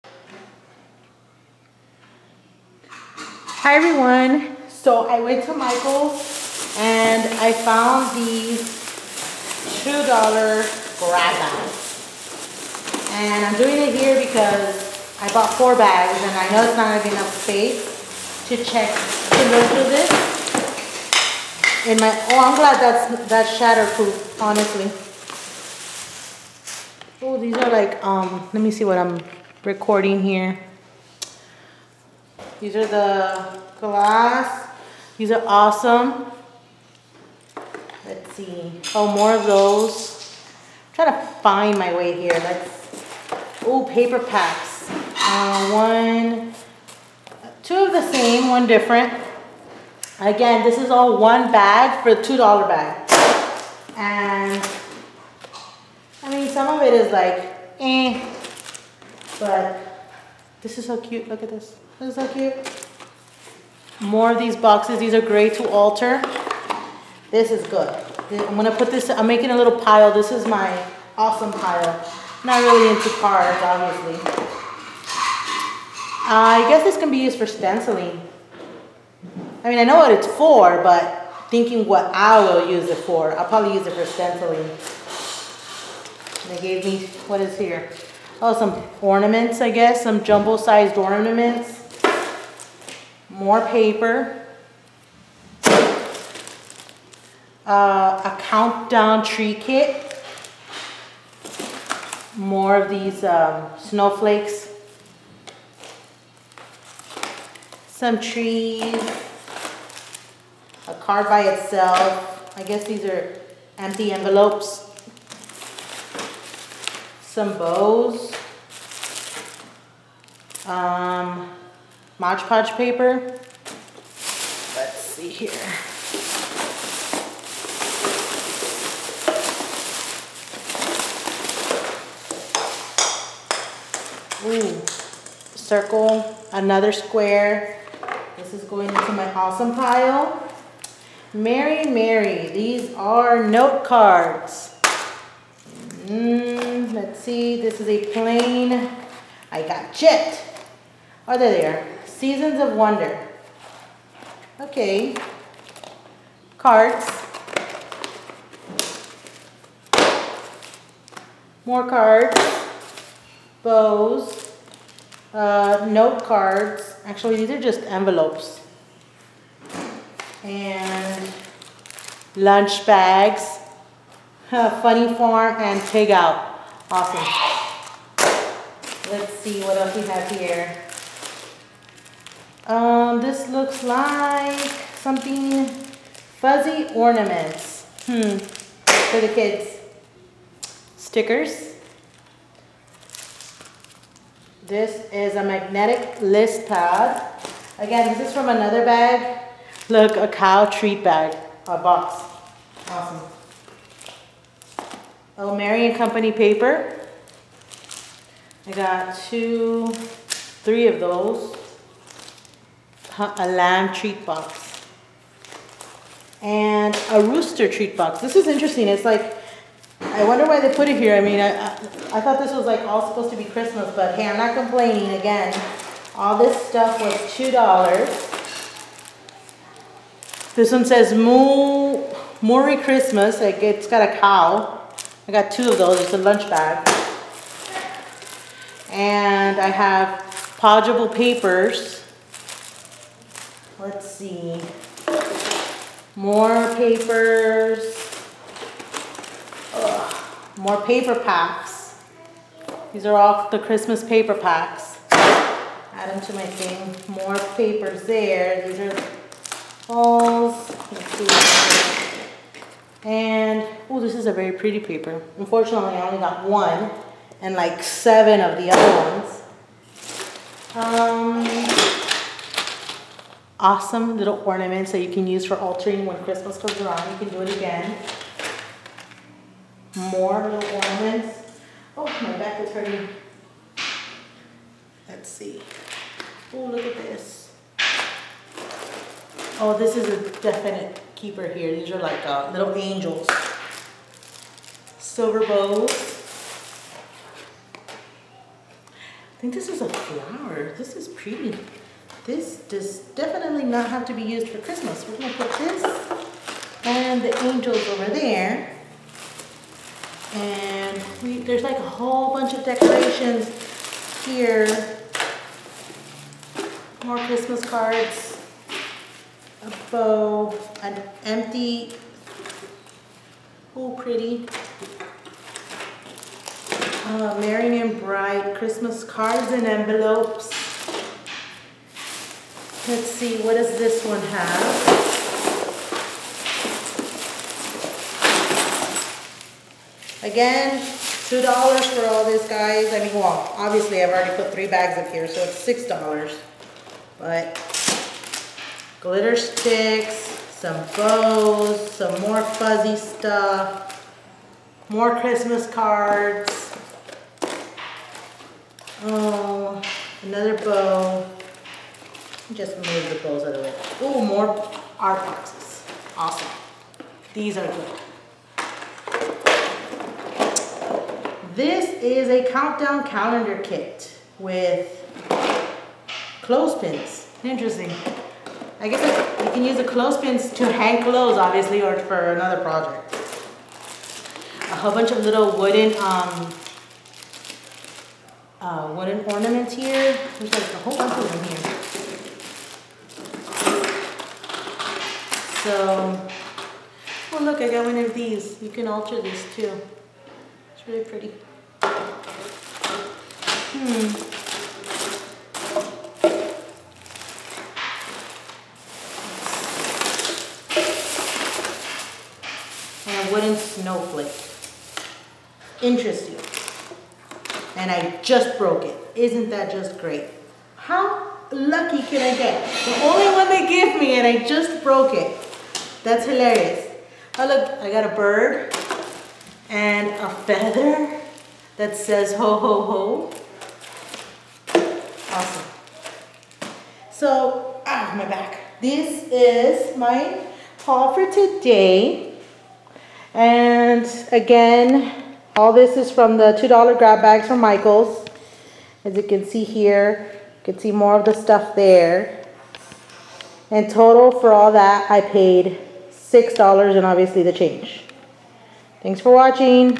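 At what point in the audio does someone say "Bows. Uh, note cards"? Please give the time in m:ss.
2:43.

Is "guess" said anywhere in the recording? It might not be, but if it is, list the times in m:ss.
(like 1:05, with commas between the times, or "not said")
1:16, 1:29, 1:52, 6:18.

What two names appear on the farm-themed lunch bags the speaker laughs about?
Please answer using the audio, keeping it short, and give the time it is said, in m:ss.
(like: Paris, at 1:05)
Funny Farm and Pig Out, at 2:54.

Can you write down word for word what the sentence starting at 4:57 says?
I think this is a flower.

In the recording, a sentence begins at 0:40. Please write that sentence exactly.
I'm trying to find my way here.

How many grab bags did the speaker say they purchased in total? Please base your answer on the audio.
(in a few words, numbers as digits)
4.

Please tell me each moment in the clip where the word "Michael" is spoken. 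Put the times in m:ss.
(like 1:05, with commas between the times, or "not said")
0:05, 7:27.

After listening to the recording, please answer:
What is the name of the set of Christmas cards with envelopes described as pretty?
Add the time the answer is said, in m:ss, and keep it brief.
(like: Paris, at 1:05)
Merry and Bright, at 5:27.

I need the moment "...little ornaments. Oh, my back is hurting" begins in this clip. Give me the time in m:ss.
4:40.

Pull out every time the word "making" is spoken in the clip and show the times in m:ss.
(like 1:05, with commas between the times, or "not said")
1:09.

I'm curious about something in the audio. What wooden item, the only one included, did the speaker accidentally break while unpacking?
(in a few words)
Wooden snowflake.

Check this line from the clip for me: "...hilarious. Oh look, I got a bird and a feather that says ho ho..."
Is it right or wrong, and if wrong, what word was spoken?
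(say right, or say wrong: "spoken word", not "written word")
right.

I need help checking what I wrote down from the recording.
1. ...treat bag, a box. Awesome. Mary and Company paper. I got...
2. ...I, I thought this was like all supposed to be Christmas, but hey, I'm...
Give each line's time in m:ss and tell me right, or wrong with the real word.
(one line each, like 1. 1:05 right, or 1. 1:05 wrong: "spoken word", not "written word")
1. 3:20 right
2. 3:41 right.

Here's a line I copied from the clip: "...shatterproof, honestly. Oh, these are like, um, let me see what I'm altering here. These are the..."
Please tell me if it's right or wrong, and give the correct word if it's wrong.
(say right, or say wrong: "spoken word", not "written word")
wrong: "recording", not "altering".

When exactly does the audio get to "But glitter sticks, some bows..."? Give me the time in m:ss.
5:47.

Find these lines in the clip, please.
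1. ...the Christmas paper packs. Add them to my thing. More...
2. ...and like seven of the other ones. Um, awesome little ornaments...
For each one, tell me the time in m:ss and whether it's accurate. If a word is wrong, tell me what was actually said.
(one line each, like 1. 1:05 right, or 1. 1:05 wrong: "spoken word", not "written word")
1. 4:13 right
2. 4:27 right.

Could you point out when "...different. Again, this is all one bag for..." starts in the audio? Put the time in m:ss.
0:48.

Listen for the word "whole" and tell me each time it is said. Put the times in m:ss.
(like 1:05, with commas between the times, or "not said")
5:11, 6:24, 6:30.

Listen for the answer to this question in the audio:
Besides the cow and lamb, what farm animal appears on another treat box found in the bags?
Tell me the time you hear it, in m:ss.
3:37.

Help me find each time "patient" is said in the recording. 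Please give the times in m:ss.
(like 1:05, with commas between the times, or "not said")
not said.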